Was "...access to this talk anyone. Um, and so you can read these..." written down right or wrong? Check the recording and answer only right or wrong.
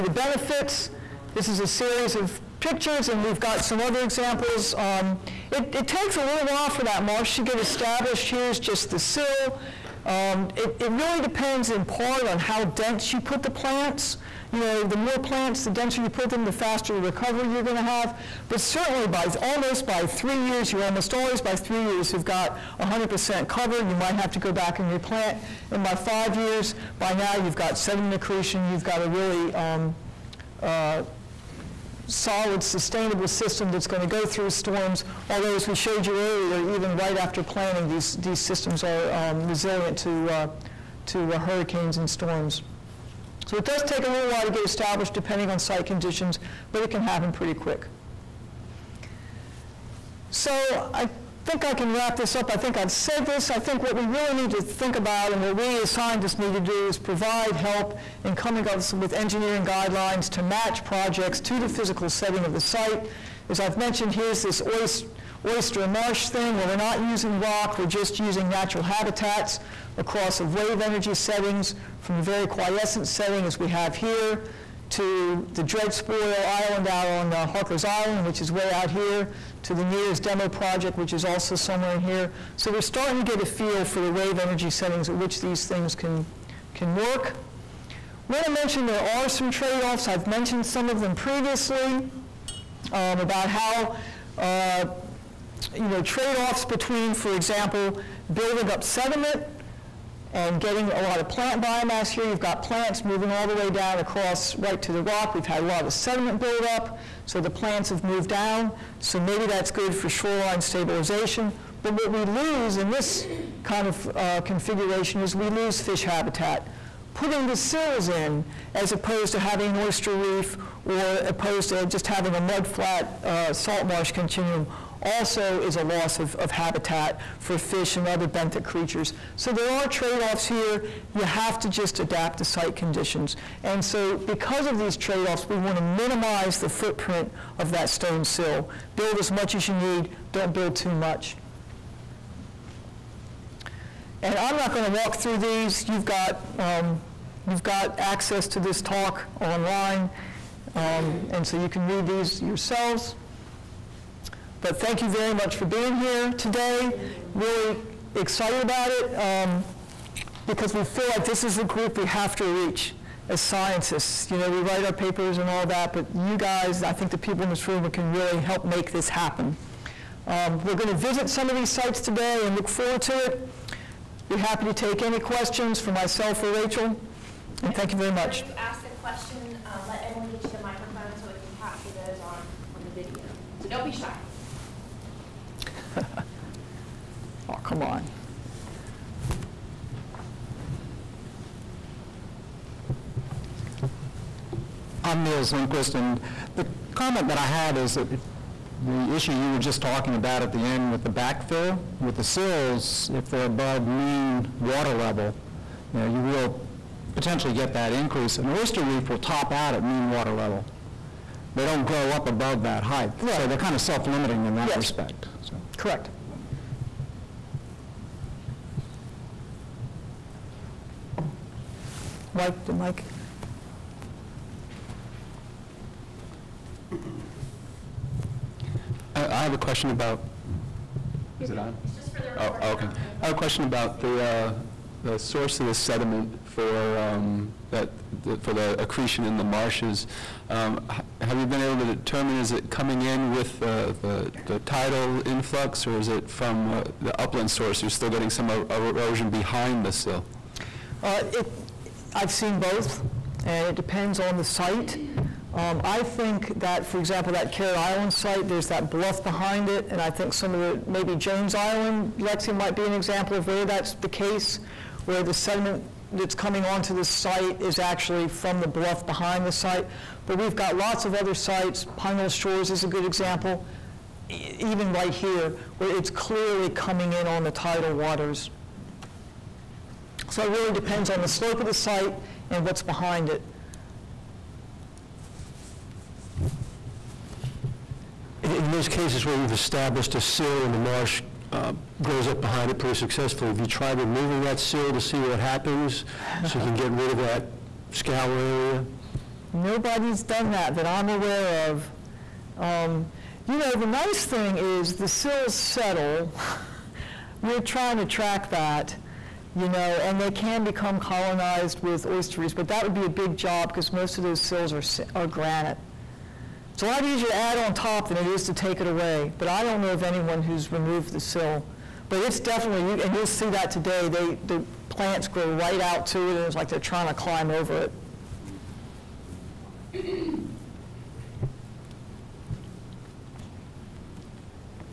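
wrong.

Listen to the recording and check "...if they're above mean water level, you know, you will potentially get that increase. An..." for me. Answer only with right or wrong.
right.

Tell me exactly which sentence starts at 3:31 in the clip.
They don't grow up above that height.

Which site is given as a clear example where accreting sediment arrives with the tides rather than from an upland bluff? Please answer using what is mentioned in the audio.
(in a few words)
Pine Knoll Shores.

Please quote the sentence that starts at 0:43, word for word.
So it does take a little while to get established depending on site conditions, but it can happen pretty quick.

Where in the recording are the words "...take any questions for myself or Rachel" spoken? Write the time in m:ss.
2:54.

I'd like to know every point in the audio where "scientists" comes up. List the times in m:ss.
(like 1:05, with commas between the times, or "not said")
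0:55, 2:43.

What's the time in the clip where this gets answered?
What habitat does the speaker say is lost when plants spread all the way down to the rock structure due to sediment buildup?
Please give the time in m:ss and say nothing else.
1:55.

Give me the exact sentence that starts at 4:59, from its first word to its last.
Nobody's done that that I'm aware of.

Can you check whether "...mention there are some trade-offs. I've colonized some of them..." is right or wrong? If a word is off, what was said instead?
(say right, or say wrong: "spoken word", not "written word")
wrong: "mentioned", not "colonized".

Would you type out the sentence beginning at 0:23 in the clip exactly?
You might have to go back and replant.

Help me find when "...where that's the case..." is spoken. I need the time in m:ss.
4:23.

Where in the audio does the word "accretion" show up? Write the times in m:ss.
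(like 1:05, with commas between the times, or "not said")
0:28, 3:58.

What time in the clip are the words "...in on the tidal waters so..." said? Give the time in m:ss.
4:37.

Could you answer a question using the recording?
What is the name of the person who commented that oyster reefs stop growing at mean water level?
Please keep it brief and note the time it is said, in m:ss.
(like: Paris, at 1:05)
Niels Lindquist, at 3:15.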